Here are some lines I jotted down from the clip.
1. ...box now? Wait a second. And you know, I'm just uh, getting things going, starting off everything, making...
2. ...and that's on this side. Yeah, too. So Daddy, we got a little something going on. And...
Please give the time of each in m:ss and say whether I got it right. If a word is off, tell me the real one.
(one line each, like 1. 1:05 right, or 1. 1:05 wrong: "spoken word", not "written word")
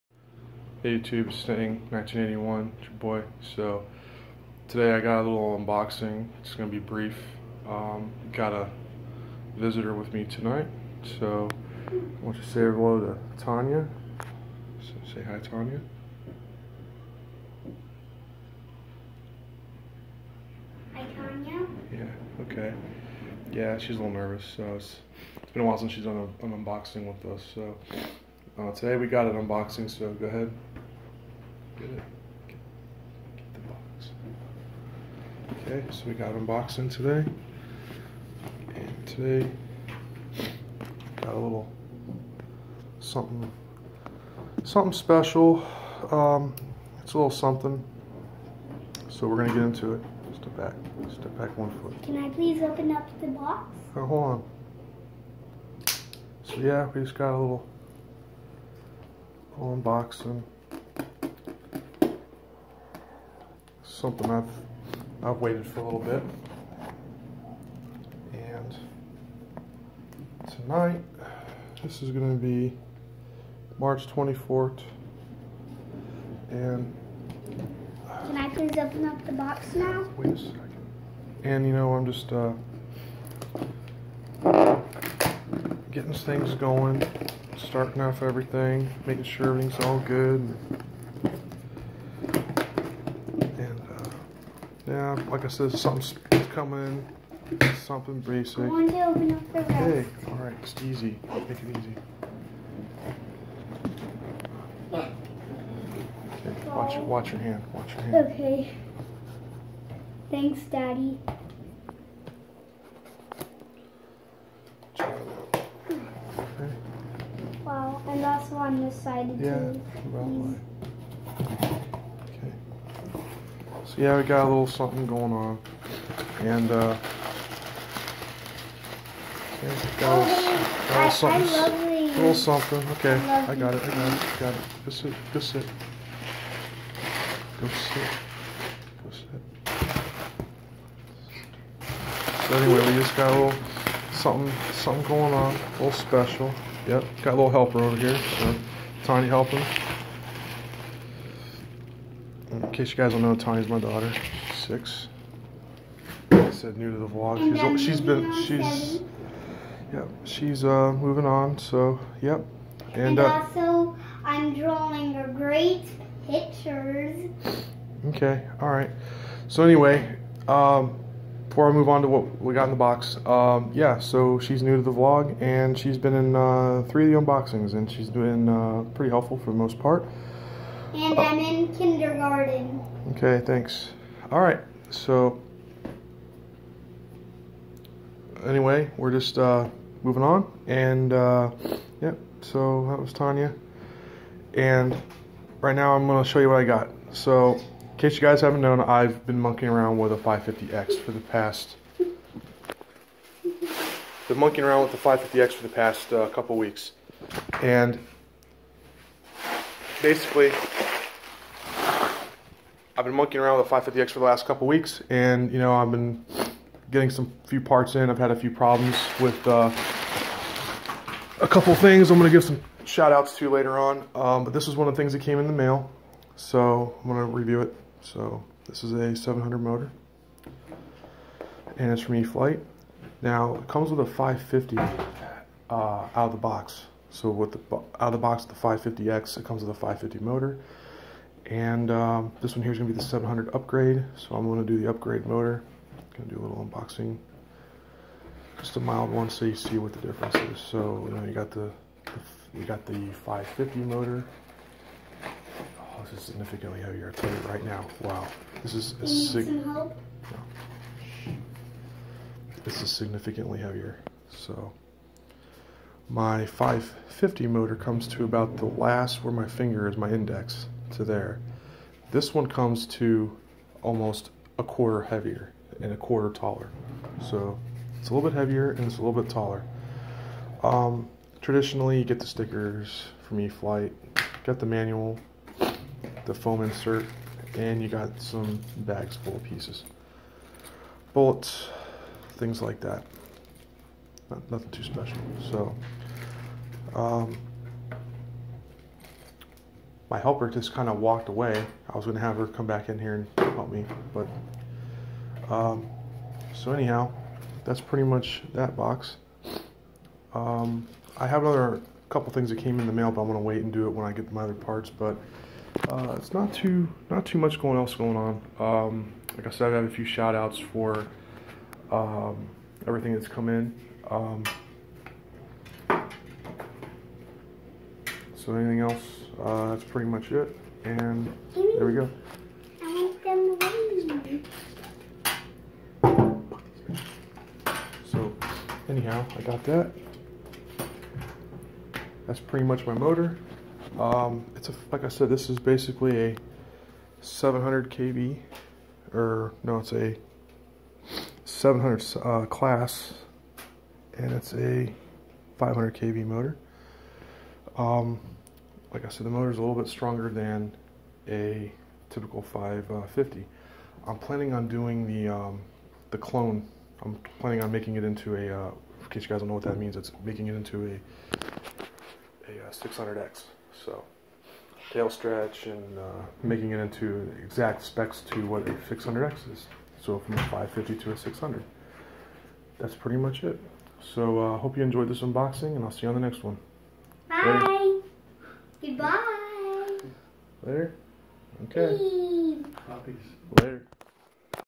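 1. 1:19 right
2. 1:58 wrong: "Yeah", not "Daddy".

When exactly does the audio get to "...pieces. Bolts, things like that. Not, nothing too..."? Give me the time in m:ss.
4:49.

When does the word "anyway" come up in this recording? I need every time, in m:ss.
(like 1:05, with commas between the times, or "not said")
2:22, 2:49, 3:08.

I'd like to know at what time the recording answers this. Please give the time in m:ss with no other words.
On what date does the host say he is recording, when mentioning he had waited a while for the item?
1:13.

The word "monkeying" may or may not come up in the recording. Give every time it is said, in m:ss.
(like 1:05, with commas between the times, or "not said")
3:19, 3:24, 3:33.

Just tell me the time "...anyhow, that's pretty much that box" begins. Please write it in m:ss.
5:06.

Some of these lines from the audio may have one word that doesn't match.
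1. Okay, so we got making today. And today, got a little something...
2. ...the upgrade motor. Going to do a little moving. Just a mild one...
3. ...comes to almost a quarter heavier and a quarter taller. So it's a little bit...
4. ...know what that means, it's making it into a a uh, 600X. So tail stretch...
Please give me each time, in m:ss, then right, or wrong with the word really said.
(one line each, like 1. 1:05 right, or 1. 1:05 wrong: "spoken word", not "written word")
1. 0:35 wrong: "unboxing", not "making"
2. 4:04 wrong: "unboxing", not "moving"
3. 4:32 right
4. 6:09 right.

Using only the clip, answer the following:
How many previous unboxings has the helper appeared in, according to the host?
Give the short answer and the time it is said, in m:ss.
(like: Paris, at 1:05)
3, at 2:56.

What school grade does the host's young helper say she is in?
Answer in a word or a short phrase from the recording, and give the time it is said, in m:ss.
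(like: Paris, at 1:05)
Kindergarten, at 3:01.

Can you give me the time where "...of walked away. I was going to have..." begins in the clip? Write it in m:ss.
5:00.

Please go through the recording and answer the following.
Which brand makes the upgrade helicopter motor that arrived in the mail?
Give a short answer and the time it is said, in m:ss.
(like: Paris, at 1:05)
E-flite, at 3:52.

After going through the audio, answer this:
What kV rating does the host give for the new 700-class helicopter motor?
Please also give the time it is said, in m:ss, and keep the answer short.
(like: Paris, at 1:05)
500 kV, at 5:55.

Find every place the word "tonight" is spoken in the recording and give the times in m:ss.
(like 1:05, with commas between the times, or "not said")
0:10, 1:10.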